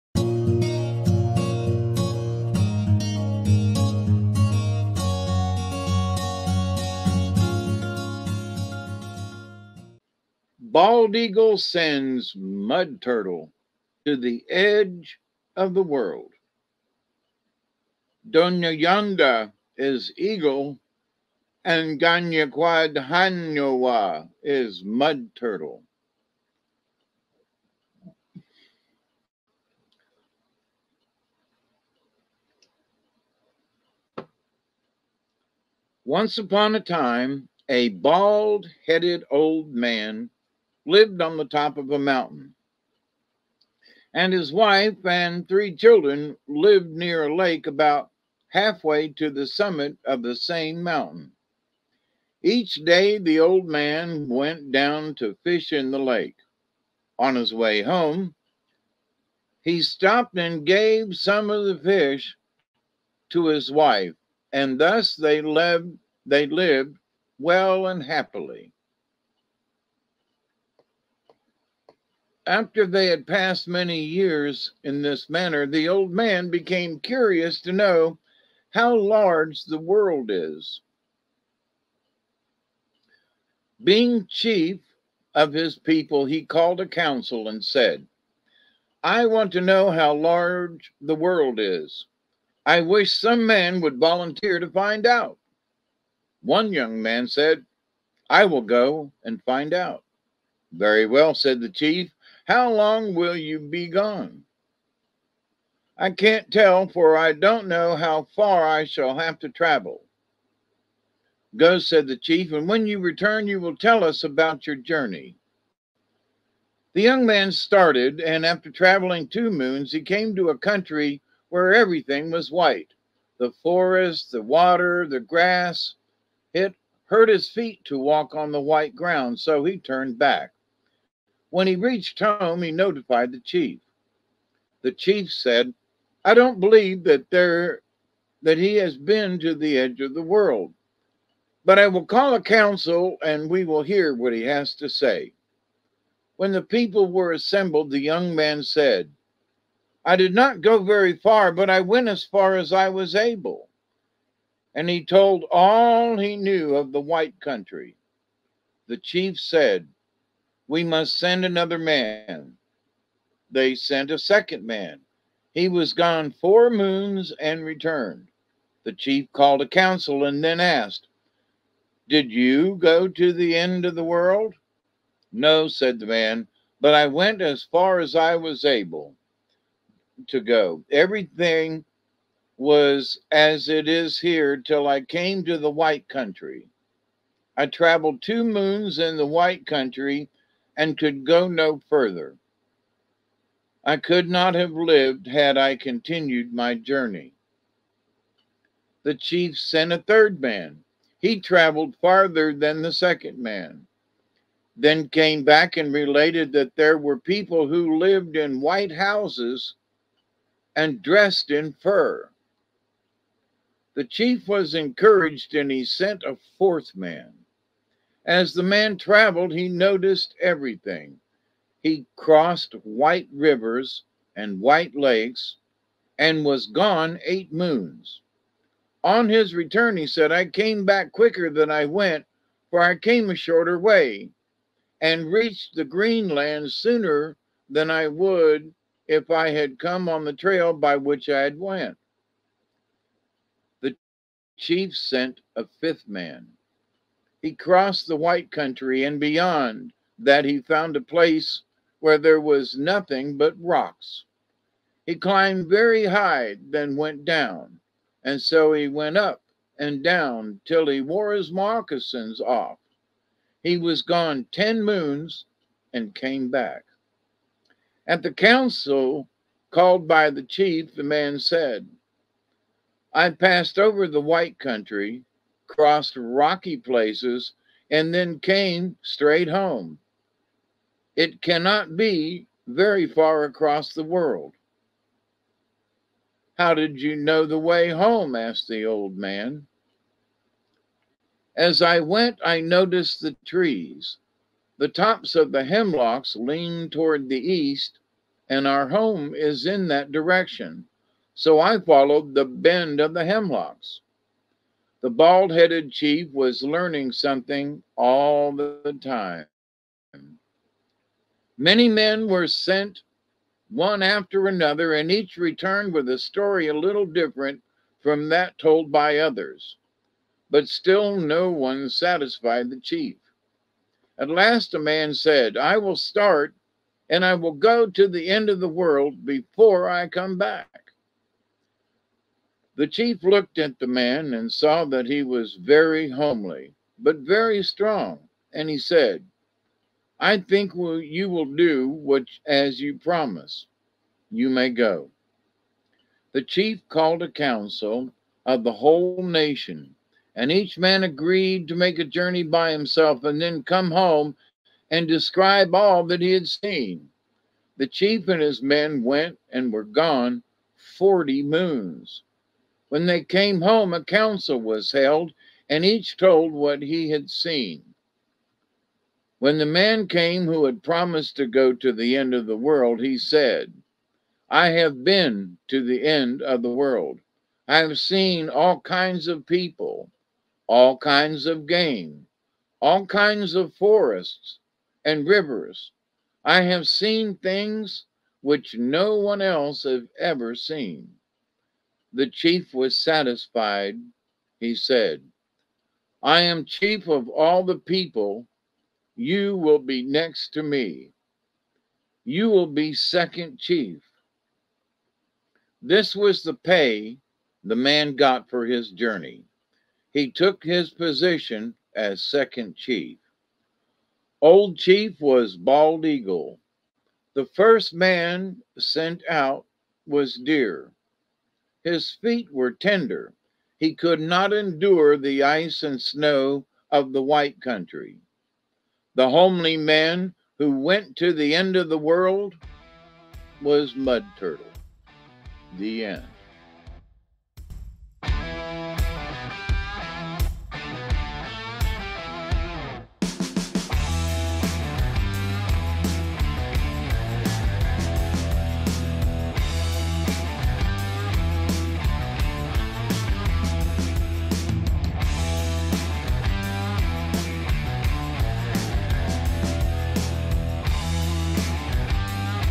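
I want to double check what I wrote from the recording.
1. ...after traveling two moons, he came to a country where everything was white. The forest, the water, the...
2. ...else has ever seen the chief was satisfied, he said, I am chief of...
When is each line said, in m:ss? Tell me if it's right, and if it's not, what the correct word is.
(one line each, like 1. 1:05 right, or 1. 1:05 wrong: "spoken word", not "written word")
1. 1:58 right
2. 6:29 right.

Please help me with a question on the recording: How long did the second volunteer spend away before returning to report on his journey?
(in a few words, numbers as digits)
4 moons.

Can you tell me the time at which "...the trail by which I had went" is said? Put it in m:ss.
4:00.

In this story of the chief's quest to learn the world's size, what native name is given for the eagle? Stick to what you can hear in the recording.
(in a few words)
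Donyanda.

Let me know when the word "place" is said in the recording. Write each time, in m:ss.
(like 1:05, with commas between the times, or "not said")
4:11, 4:36.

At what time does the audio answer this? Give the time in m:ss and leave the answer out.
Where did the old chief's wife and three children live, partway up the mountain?
0:46.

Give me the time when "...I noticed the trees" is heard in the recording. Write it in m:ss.
4:52.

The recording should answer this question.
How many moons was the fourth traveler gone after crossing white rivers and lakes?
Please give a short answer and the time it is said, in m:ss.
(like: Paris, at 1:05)
8, at 3:47.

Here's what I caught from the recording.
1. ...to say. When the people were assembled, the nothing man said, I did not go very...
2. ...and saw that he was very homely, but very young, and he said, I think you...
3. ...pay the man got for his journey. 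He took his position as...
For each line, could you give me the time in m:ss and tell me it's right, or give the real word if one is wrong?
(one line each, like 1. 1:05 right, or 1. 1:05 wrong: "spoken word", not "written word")
1. 2:24 wrong: "young", not "nothing"
2. 5:34 wrong: "strong", not "young"
3. 6:46 right.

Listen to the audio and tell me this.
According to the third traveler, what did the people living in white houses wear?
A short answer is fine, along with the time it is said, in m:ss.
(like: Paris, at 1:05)
fur, at 3:31.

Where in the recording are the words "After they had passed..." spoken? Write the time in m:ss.
1:12.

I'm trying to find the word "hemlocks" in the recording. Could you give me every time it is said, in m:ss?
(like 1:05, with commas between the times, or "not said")
4:55, 5:03.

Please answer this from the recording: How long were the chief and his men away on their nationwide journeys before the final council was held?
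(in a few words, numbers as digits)
40 moons.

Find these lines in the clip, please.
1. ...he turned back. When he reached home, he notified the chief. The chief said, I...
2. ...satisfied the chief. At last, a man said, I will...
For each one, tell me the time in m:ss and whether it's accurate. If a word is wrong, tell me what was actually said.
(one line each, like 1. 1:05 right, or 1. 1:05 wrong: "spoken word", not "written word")
1. 2:09 right
2. 5:21 right.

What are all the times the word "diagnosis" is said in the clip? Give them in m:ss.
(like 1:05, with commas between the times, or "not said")
not said.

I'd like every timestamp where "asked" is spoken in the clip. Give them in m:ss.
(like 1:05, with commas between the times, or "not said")
2:50, 4:48.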